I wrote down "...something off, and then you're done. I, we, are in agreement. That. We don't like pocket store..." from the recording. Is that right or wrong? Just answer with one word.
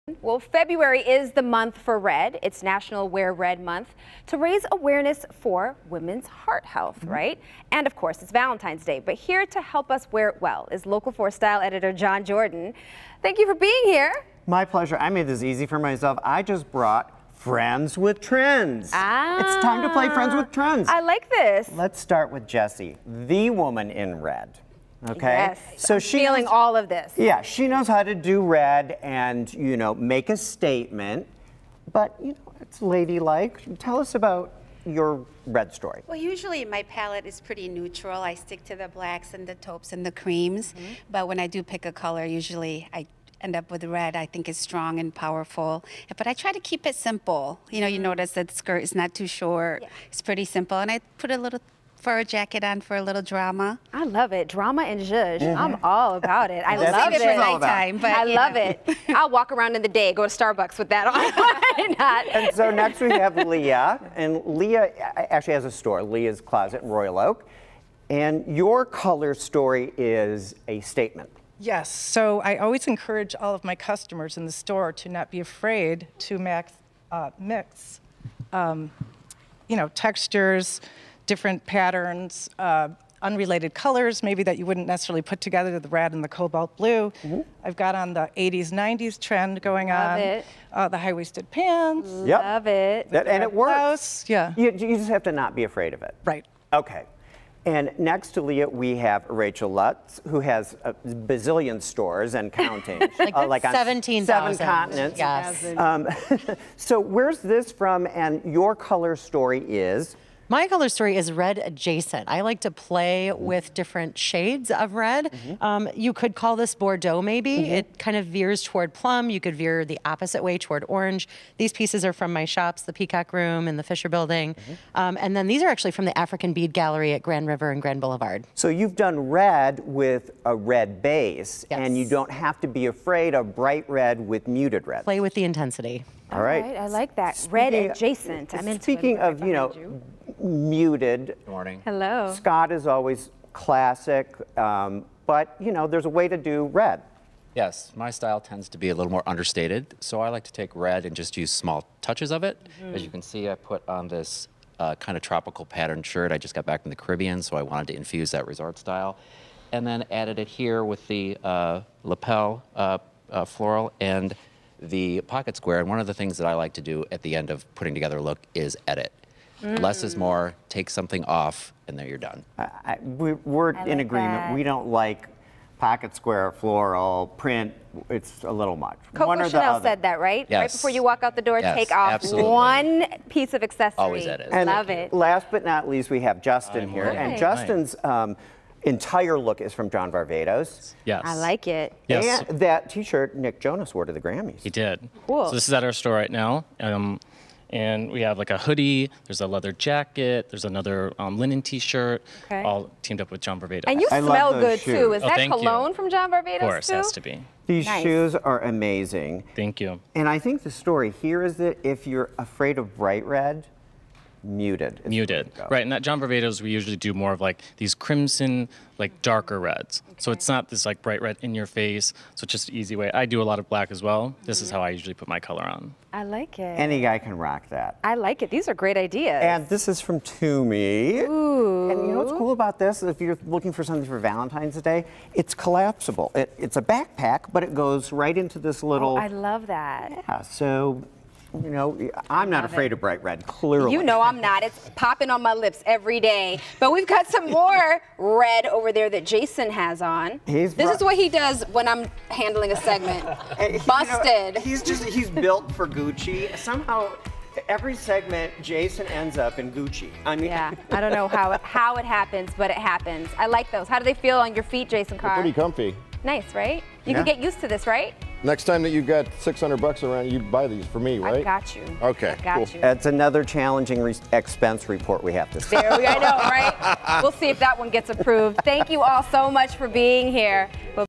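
wrong.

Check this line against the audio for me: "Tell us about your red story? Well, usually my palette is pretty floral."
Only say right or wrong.
wrong.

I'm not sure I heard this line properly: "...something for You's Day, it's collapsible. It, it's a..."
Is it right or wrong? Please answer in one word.
wrong.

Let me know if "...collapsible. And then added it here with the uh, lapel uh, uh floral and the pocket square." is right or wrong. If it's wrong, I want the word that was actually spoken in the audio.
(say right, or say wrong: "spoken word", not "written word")
wrong: "style", not "collapsible".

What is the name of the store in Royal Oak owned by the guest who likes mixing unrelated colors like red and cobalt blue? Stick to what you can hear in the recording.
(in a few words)
Leah's Closet.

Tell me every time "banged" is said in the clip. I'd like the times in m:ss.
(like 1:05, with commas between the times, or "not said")
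not said.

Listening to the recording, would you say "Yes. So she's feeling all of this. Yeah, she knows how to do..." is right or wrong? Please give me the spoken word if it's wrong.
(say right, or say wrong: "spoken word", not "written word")
right.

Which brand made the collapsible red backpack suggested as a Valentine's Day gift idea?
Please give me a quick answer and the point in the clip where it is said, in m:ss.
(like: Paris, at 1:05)
Tumi, at 3:50.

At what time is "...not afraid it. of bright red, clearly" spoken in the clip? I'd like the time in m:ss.
4:02.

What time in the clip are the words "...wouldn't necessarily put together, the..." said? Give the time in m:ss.
1:24.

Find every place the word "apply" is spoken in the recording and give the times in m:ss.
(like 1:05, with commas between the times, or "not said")
not said.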